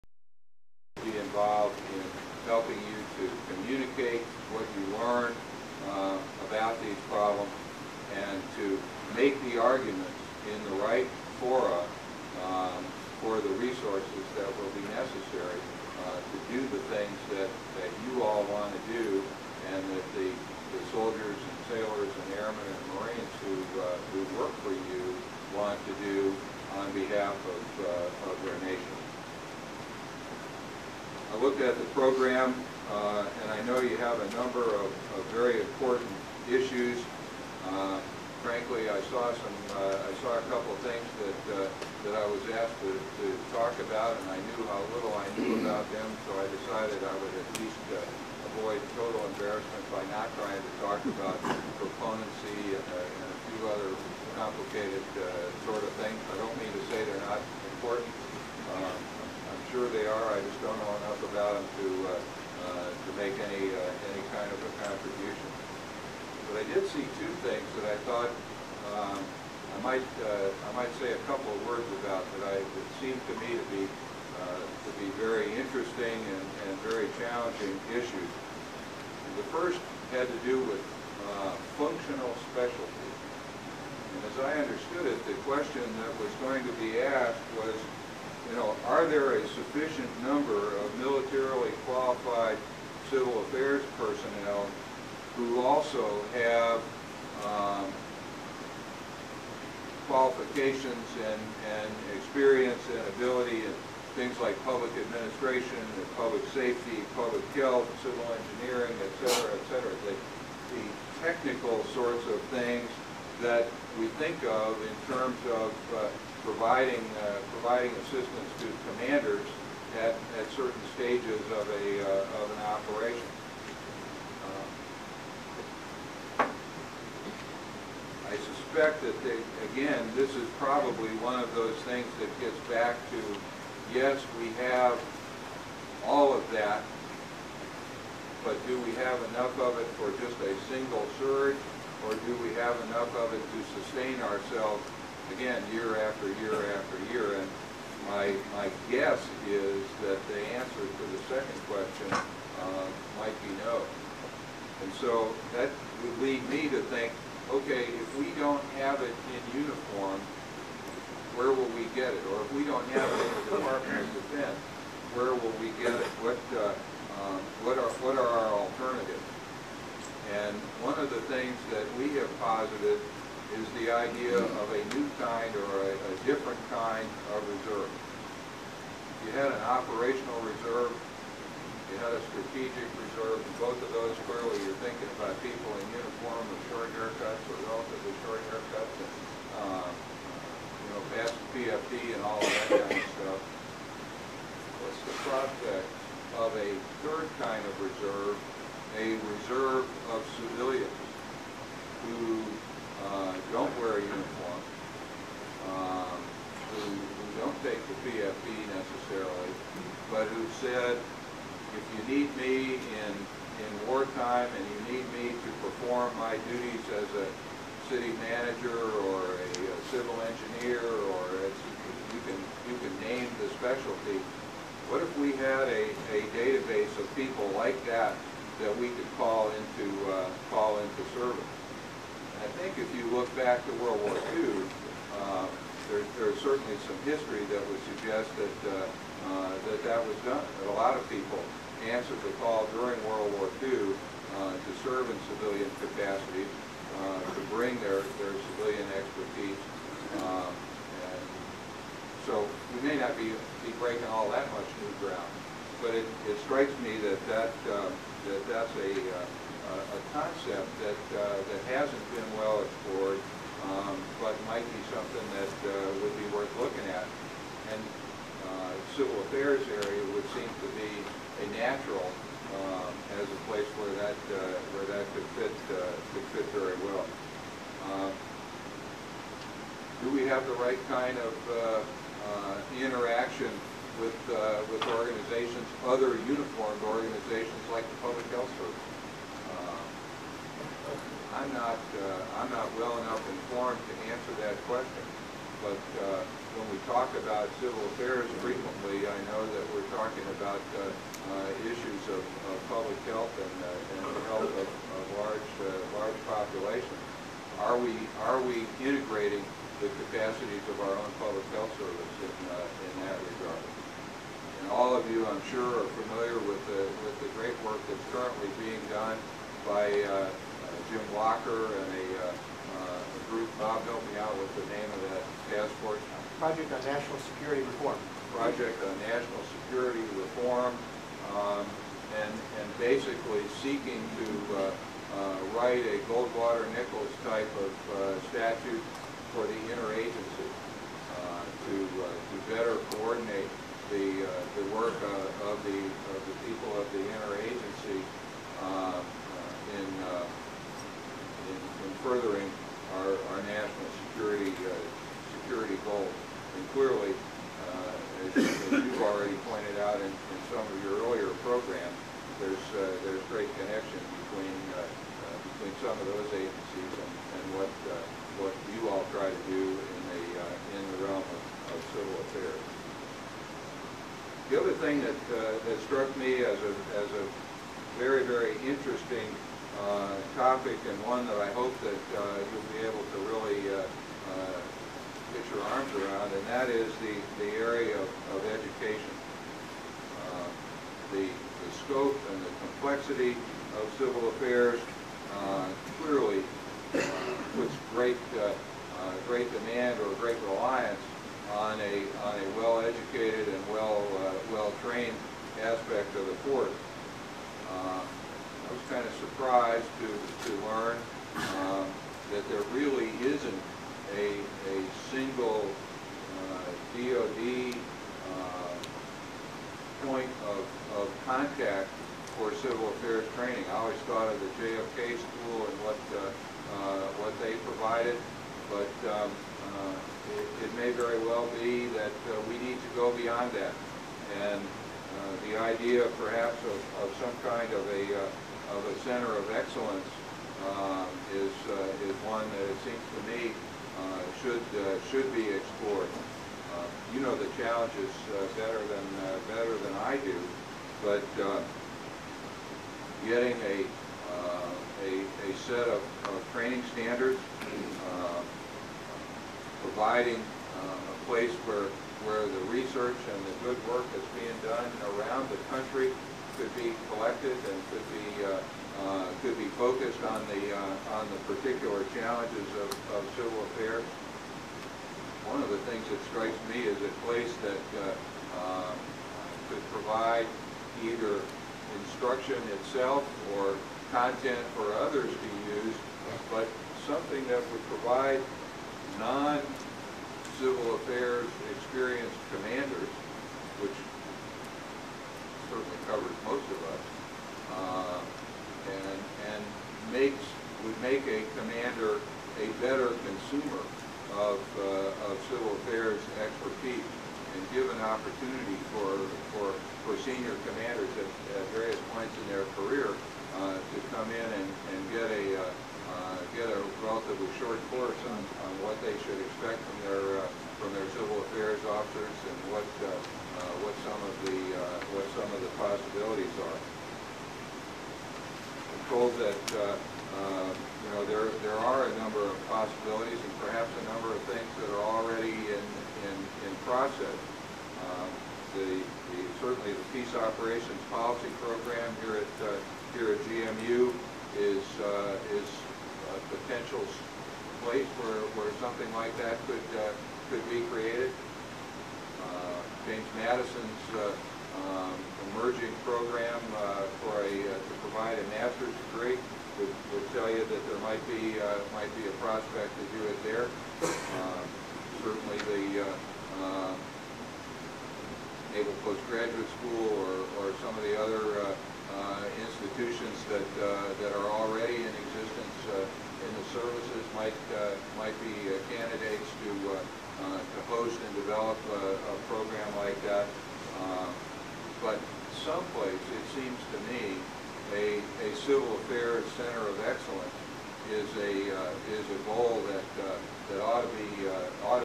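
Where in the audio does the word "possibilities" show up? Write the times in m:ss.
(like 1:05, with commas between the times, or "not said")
8:45, 8:52.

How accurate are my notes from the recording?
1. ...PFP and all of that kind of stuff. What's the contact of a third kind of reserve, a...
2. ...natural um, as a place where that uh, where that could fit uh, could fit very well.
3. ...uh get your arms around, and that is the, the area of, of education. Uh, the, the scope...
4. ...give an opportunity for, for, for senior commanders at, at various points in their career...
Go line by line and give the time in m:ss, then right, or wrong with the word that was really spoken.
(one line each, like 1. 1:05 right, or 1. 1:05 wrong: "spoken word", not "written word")
1. 3:11 wrong: "prospect", not "contact"
2. 4:31 right
3. 6:23 right
4. 8:27 right.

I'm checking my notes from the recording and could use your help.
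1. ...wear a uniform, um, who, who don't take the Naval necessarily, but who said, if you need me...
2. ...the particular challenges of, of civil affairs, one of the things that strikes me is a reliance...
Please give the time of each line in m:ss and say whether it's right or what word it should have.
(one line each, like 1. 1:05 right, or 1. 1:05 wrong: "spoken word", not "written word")
1. 3:23 wrong: "PFP", not "Naval"
2. 7:51 wrong: "place", not "reliance".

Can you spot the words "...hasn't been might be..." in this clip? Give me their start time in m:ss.
4:21.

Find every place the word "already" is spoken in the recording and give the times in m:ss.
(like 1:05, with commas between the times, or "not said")
5:59, 8:55, 9:34.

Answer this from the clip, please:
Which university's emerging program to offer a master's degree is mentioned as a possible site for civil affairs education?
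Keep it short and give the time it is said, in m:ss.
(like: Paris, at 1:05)
James Madison, at 9:13.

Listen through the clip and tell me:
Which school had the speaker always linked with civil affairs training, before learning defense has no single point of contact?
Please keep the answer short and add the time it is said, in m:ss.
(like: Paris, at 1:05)
JFK school, at 7:04.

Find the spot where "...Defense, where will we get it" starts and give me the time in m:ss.
2:44.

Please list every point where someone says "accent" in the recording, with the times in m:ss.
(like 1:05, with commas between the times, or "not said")
not said.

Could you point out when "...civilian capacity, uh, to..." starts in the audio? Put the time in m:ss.
4:05.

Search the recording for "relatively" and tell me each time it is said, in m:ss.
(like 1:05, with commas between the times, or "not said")
3:07, 8:37.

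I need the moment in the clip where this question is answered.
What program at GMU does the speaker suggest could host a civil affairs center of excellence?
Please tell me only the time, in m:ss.
9:00.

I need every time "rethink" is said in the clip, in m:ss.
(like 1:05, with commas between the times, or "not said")
not said.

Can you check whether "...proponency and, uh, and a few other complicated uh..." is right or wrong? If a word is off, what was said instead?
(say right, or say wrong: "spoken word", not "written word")
right.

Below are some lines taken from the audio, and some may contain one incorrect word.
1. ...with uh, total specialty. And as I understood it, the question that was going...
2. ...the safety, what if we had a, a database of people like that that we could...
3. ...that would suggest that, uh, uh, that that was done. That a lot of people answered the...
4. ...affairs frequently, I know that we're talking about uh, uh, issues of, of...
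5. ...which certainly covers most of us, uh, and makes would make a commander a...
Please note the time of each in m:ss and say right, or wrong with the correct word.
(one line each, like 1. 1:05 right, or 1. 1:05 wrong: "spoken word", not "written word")
1. 1:20 wrong: "functional", not "total"
2. 3:43 wrong: "specialty", not "safety"
3. 3:57 right
4. 4:57 right
5. 8:13 right.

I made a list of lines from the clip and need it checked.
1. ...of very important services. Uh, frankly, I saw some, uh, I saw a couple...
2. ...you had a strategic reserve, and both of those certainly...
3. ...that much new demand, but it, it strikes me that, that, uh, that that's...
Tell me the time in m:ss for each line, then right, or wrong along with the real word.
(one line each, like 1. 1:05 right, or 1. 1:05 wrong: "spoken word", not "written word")
1. 0:35 wrong: "issues", not "services"
2. 3:01 wrong: "clearly", not "certainly"
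3. 4:14 wrong: "ground", not "demand".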